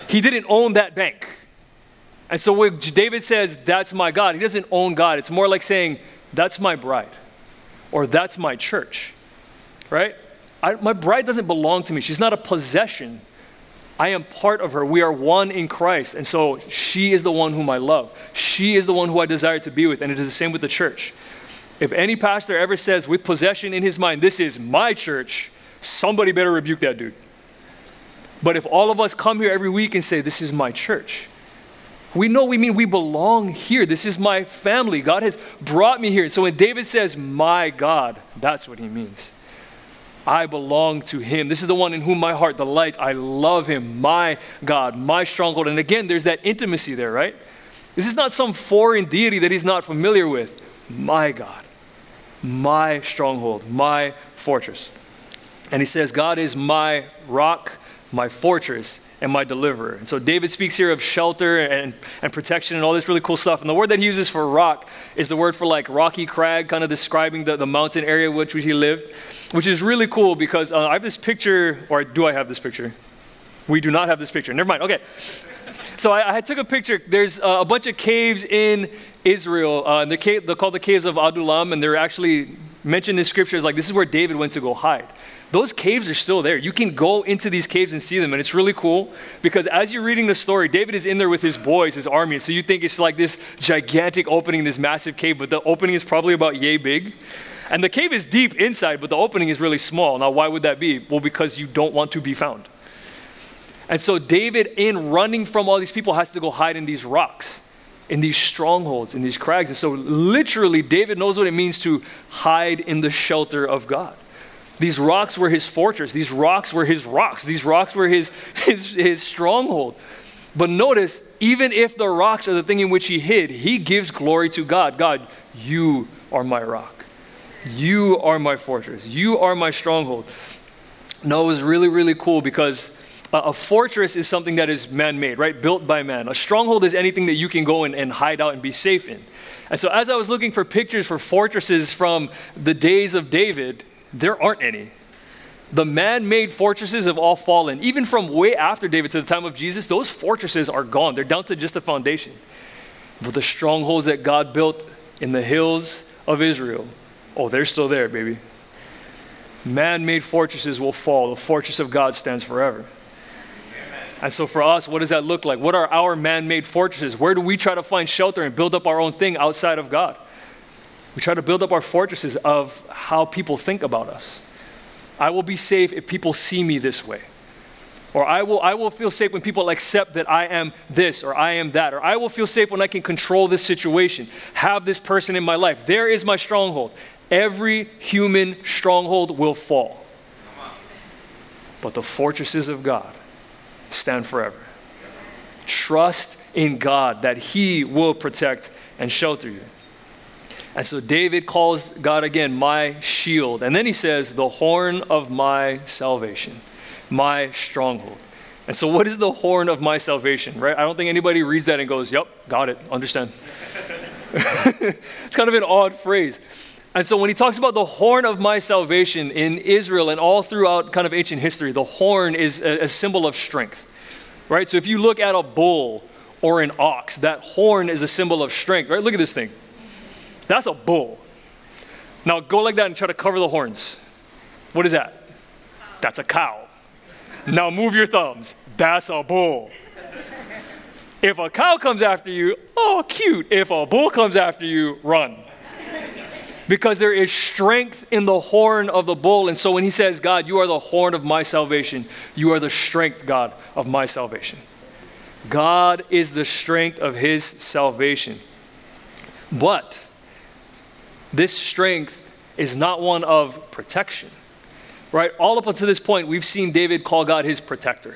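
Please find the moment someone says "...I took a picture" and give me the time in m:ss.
1:16.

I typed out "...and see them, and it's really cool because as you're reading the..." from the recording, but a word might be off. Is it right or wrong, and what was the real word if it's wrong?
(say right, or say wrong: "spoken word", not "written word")
right.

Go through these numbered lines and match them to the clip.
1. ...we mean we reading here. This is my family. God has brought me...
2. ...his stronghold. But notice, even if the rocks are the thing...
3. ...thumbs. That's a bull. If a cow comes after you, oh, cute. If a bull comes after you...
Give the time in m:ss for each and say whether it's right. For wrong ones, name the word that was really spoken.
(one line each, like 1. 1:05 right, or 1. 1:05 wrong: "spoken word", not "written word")
1. 0:32 wrong: "belong", not "reading"
2. 1:58 right
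3. 3:58 right.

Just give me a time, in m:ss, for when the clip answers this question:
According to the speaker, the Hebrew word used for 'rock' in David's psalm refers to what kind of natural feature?
1:05.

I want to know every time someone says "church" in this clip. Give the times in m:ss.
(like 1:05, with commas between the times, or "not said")
0:08, 0:20, 0:24, 0:30.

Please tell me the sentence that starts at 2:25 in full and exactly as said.
The man made fortresses have all fallen.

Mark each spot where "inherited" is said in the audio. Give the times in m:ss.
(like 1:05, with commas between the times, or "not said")
not said.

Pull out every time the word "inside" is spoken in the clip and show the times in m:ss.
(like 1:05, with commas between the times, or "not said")
1:38.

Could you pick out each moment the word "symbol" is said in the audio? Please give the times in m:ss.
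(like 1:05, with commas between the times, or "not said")
3:42, 3:48.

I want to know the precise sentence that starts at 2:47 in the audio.
Where do we try to find shelter and build up our own thing outside of God?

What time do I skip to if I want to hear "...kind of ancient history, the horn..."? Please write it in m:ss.
3:40.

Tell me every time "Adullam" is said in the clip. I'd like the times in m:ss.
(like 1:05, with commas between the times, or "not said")
1:21.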